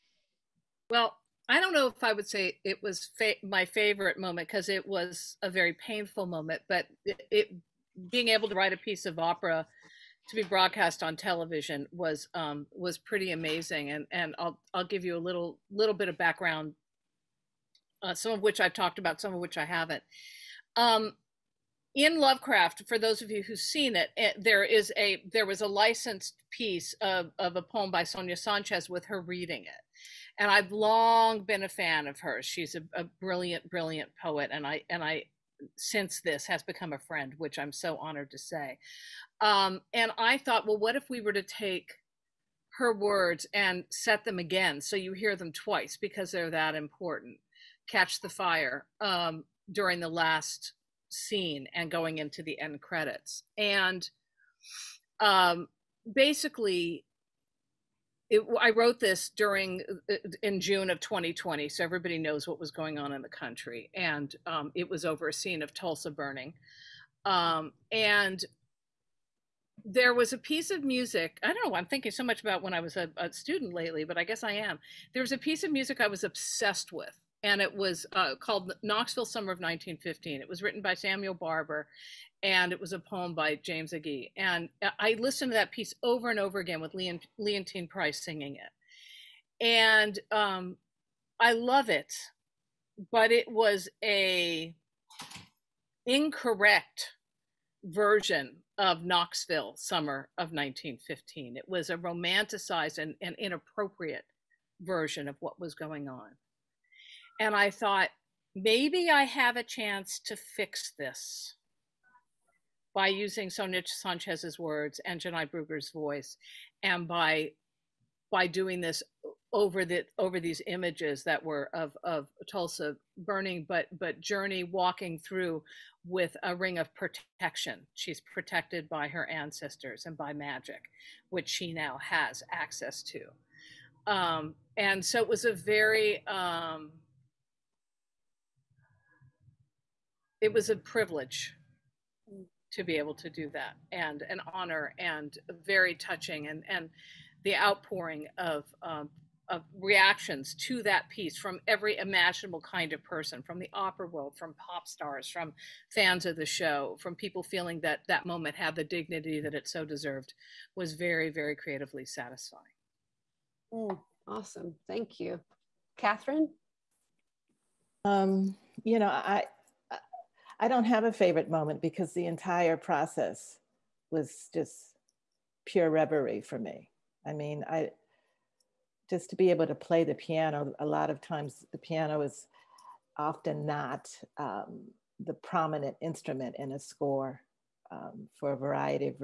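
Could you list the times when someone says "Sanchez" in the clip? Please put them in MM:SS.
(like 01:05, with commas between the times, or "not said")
00:28, 01:53.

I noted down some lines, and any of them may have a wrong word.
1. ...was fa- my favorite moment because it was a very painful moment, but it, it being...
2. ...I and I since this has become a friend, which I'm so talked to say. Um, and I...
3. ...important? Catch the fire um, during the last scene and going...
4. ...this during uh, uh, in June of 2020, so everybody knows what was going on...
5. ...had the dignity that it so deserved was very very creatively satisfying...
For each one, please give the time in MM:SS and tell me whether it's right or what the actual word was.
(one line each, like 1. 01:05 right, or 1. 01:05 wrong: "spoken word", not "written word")
1. 00:02 right
2. 00:34 wrong: "honored", not "talked"
3. 00:46 right
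4. 00:58 right
5. 02:38 right.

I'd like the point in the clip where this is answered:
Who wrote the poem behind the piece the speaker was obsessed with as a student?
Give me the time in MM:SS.
01:23.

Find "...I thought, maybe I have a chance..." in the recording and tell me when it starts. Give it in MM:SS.
01:47.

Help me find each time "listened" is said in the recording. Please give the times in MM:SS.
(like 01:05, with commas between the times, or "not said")
01:25.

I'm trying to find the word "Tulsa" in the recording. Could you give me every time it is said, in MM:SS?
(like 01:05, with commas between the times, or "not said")
01:05, 02:02.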